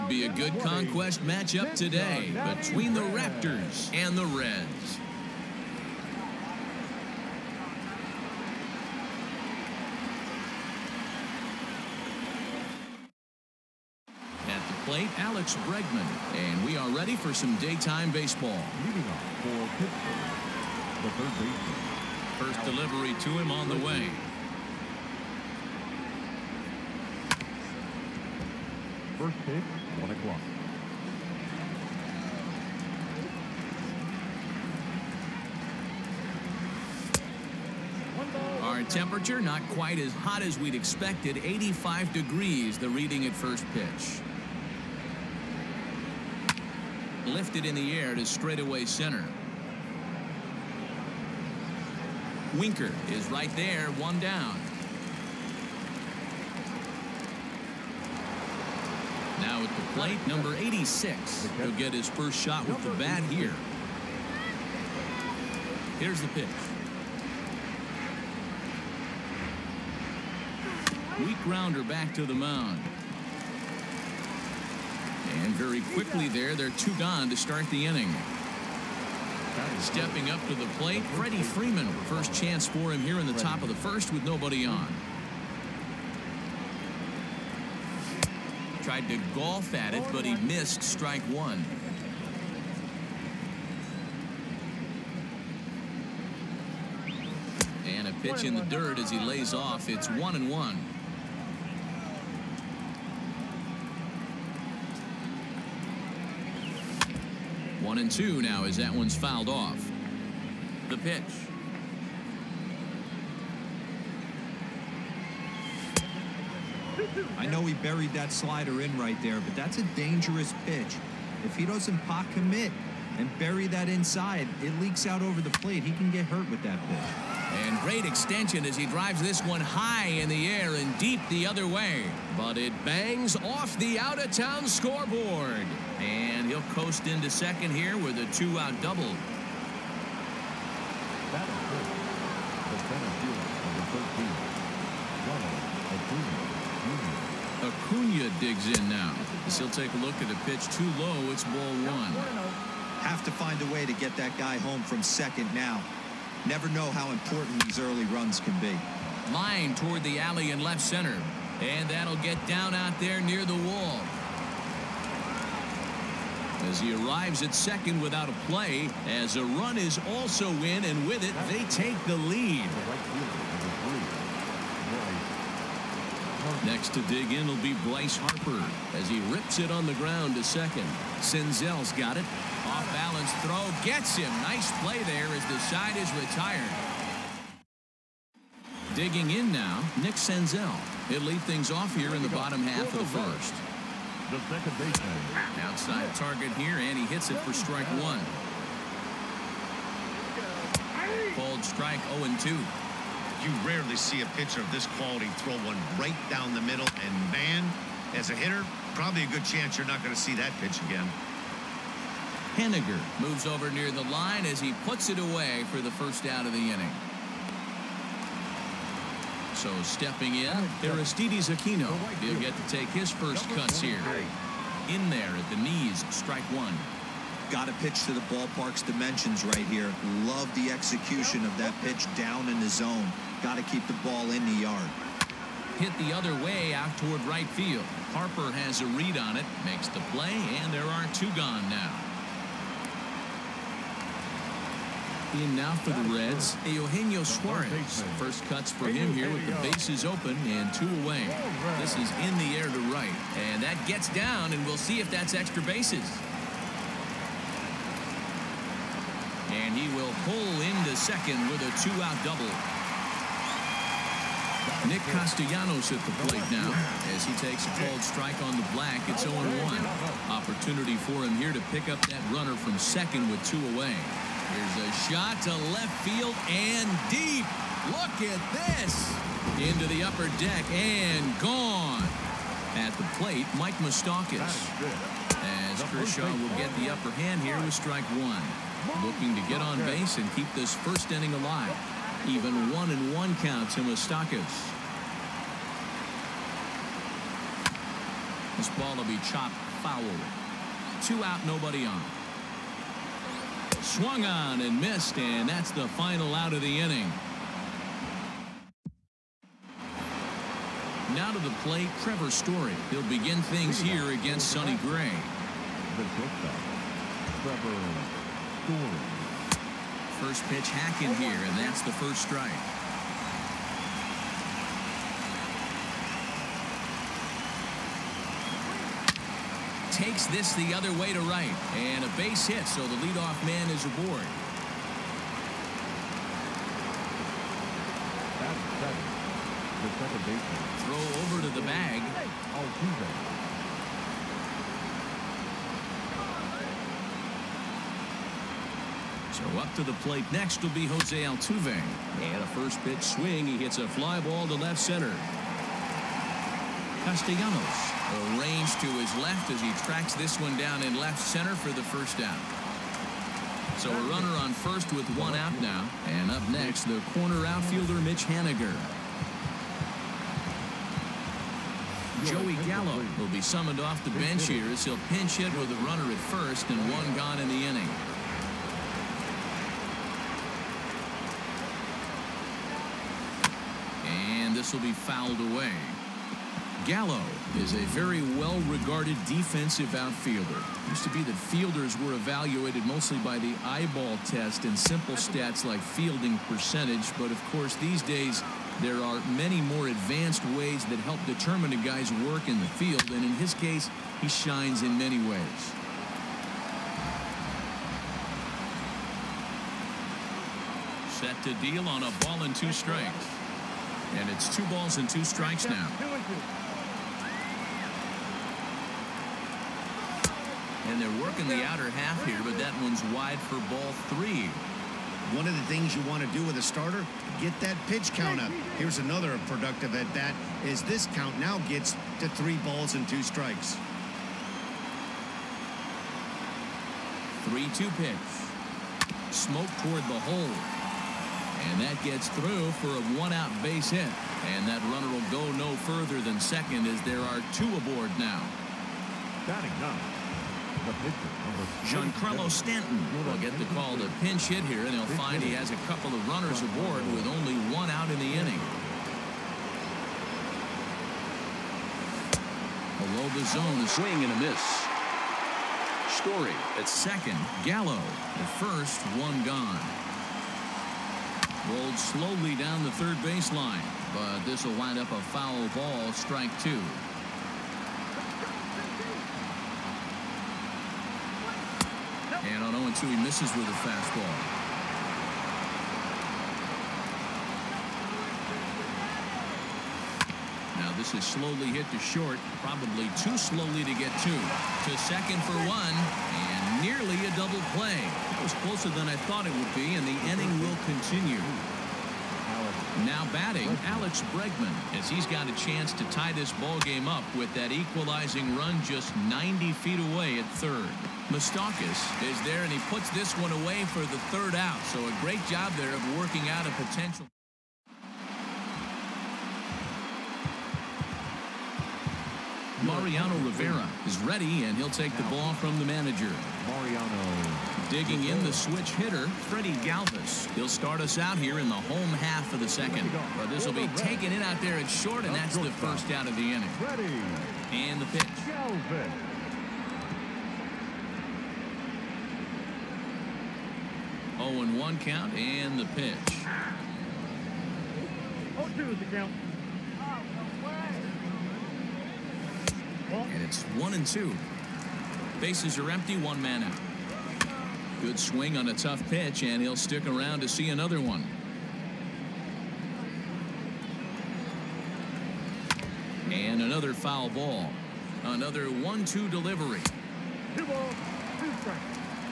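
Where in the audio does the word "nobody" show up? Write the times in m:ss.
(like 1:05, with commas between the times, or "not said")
1:24, 5:01.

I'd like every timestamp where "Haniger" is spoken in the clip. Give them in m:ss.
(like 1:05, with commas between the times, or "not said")
3:32, 6:08.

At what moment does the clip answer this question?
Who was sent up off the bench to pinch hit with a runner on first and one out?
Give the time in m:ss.
6:12.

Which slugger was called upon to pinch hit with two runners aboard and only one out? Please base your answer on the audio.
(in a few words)
Giancarlo Stanton.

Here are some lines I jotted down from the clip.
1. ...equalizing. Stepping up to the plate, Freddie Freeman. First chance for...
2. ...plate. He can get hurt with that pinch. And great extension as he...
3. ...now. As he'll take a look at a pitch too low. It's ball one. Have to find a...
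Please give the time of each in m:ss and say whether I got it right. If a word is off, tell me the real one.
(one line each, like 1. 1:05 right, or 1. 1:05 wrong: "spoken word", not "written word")
1. 1:17 wrong: "inning", not "equalizing"
2. 2:05 wrong: "pitch", not "pinch"
3. 2:28 right.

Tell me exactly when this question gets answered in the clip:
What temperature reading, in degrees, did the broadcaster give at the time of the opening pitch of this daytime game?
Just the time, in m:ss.
0:41.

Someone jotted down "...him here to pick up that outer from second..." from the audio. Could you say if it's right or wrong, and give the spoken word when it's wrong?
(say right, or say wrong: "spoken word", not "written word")
wrong: "runner", not "outer".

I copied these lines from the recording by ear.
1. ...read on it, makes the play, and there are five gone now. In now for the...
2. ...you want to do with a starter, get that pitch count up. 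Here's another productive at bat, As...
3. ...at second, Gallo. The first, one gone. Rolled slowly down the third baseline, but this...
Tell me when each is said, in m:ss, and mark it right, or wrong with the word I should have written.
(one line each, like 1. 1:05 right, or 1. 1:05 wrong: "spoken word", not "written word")
1. 3:58 wrong: "two", not "five"
2. 7:05 right
3. 7:46 right.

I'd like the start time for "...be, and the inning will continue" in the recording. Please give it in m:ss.
8:19.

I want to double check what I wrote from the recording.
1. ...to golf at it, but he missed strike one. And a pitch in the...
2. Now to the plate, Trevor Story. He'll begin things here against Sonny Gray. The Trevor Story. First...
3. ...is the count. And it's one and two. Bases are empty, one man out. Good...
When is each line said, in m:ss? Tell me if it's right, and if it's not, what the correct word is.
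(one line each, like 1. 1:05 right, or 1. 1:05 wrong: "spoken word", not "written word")
1. 1:29 right
2. 5:11 right
3. 9:08 right.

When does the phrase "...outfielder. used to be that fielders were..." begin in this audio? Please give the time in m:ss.
6:29.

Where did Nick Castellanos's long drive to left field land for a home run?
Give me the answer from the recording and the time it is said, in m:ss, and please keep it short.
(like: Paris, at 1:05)
the upper deck, at 4:40.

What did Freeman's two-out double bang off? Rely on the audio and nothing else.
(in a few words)
the out-of-town scoreboard.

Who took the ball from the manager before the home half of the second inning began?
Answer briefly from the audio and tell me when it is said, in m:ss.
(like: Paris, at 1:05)
Mariano Rivera, at 8:43.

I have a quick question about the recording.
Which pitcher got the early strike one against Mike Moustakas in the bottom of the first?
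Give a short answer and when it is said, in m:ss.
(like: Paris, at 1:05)
Kershaw, at 4:45.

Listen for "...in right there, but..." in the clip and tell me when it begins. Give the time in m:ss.
1:58.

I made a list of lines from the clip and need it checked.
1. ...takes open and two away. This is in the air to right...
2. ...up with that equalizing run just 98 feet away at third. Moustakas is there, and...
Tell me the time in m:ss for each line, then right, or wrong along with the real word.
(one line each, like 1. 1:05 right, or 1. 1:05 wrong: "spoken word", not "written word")
1. 4:09 wrong: "bases", not "takes"
2. 8:27 wrong: "90", not "98".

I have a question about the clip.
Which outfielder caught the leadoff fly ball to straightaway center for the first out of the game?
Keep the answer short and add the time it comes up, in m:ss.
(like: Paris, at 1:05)
Winker, at 0:52.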